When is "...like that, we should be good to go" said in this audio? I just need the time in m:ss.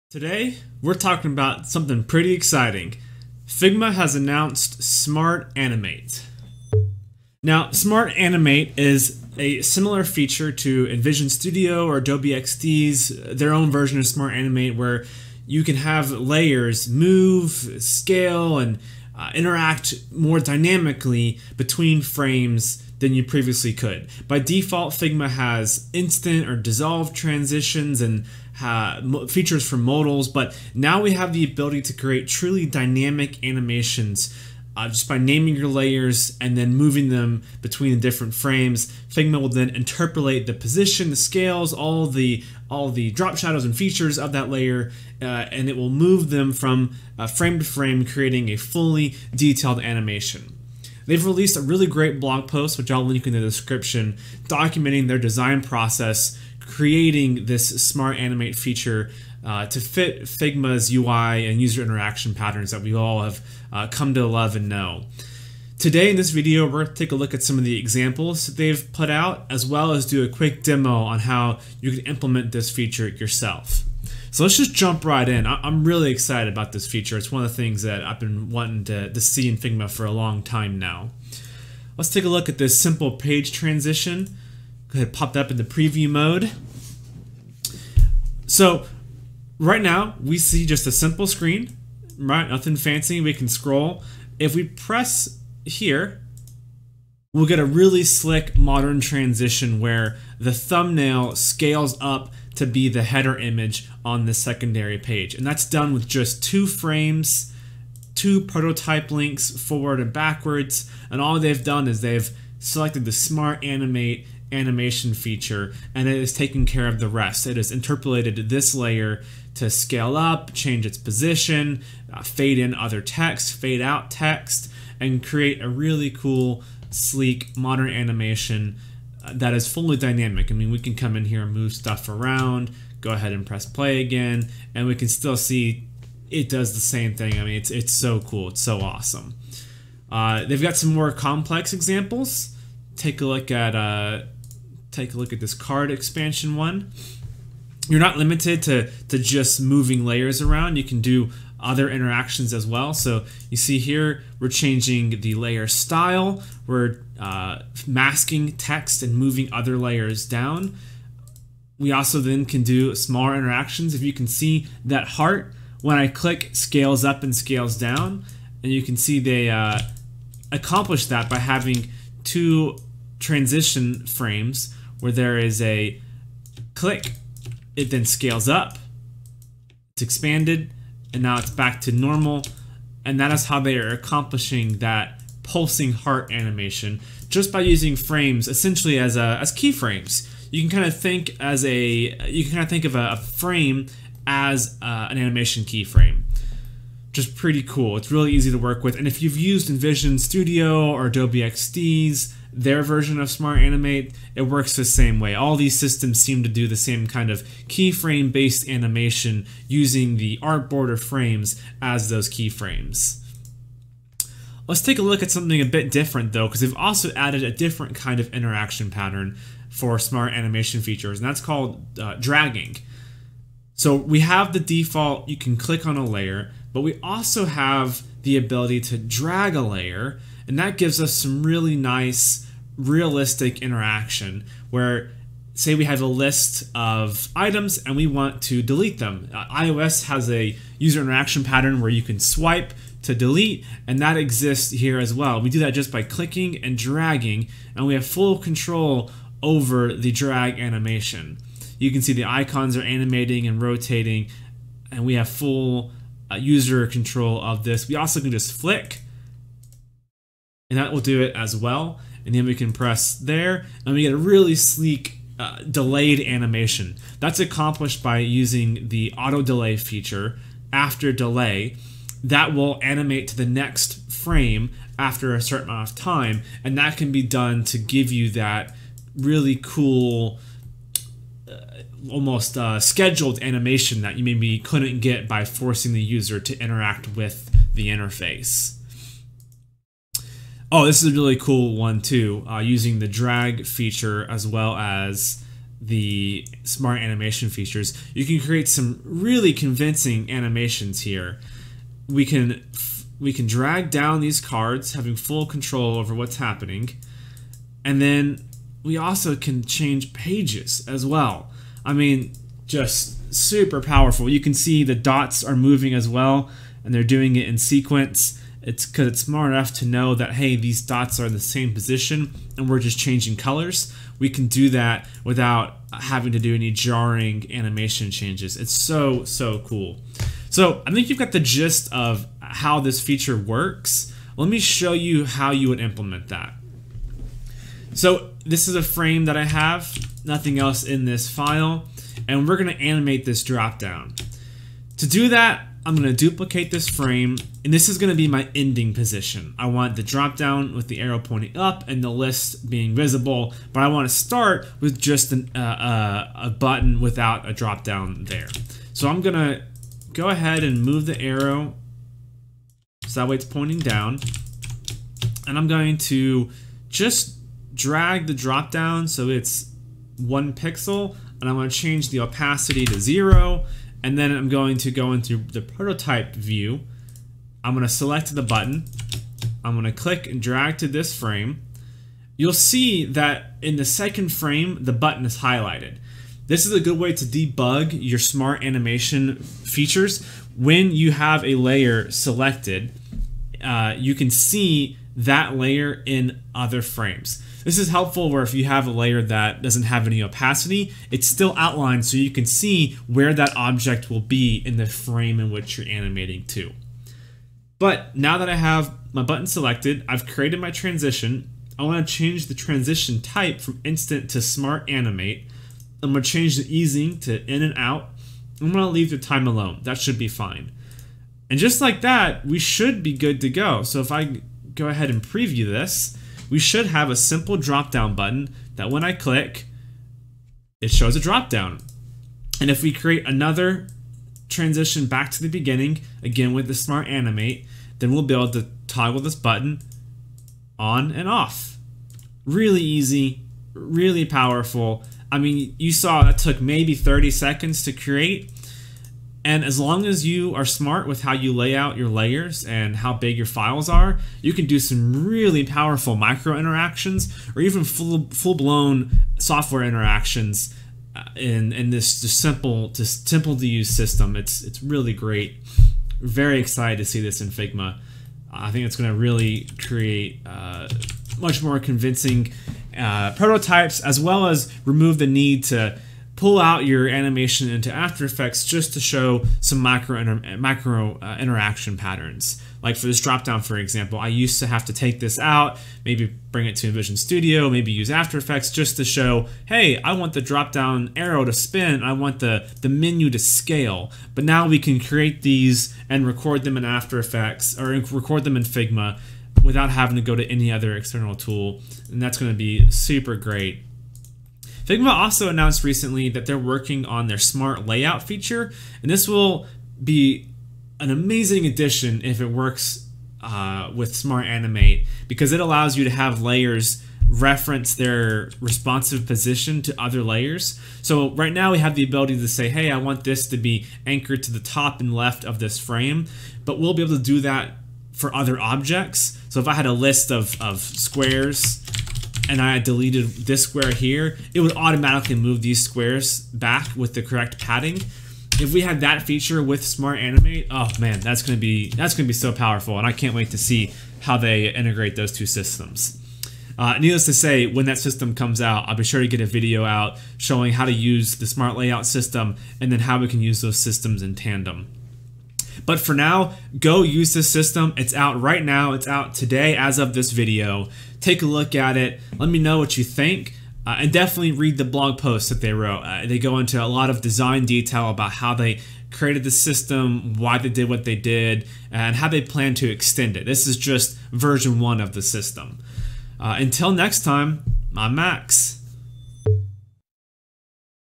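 7:01.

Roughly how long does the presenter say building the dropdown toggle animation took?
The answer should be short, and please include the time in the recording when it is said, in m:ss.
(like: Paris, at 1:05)
30 seconds, at 7:26.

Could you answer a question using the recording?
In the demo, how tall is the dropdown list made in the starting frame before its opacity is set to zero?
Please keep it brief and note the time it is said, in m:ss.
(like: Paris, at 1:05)
1 pixel, at 6:10.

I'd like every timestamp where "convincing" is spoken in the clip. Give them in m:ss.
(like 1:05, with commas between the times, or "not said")
4:59, 7:51.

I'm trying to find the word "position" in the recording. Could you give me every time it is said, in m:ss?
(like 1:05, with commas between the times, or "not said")
0:40, 2:00, 5:21, 5:48, 8:39.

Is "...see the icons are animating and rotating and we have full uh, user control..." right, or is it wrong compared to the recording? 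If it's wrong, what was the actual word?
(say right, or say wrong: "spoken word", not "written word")
right.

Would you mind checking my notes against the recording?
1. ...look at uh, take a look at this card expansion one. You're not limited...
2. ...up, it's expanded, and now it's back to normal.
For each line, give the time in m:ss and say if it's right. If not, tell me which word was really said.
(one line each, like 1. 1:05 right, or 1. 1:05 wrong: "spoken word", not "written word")
1. 2:23 right
2. 2:58 right.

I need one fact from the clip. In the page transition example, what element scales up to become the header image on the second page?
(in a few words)
The thumbnail.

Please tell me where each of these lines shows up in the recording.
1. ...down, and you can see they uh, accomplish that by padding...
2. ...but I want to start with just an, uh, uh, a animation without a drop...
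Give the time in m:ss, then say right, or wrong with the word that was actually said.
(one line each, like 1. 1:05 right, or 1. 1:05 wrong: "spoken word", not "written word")
1. 2:47 wrong: "having", not "padding"
2. 5:53 wrong: "button", not "animation".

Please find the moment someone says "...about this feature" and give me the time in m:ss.
1:16.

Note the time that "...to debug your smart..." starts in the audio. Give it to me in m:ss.
6:27.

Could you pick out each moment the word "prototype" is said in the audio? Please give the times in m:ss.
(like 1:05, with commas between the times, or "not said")
1:48, 6:15, 7:53.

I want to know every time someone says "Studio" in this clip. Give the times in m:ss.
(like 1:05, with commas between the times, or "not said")
0:11, 3:20, 8:07.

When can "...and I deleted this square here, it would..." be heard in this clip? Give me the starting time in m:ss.
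8:52.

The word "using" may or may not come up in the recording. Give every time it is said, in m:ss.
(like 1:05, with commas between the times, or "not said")
3:07, 3:29, 4:28, 4:52.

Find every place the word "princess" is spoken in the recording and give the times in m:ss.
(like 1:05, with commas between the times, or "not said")
not said.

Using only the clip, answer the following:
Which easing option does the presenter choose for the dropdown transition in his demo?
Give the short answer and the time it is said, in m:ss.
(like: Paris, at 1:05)
In and out, at 6:57.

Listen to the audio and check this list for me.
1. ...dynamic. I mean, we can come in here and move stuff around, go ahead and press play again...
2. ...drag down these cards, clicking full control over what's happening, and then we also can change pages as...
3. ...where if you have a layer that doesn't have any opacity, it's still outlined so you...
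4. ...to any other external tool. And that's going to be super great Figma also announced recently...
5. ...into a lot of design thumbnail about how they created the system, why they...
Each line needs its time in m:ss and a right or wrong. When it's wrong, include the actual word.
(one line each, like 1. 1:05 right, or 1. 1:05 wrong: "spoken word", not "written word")
1. 2:09 right
2. 5:03 wrong: "having", not "clicking"
3. 6:38 right
4. 8:20 right
5. 9:26 wrong: "detail", not "thumbnail".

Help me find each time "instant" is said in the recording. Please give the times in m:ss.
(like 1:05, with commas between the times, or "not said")
0:25, 6:53.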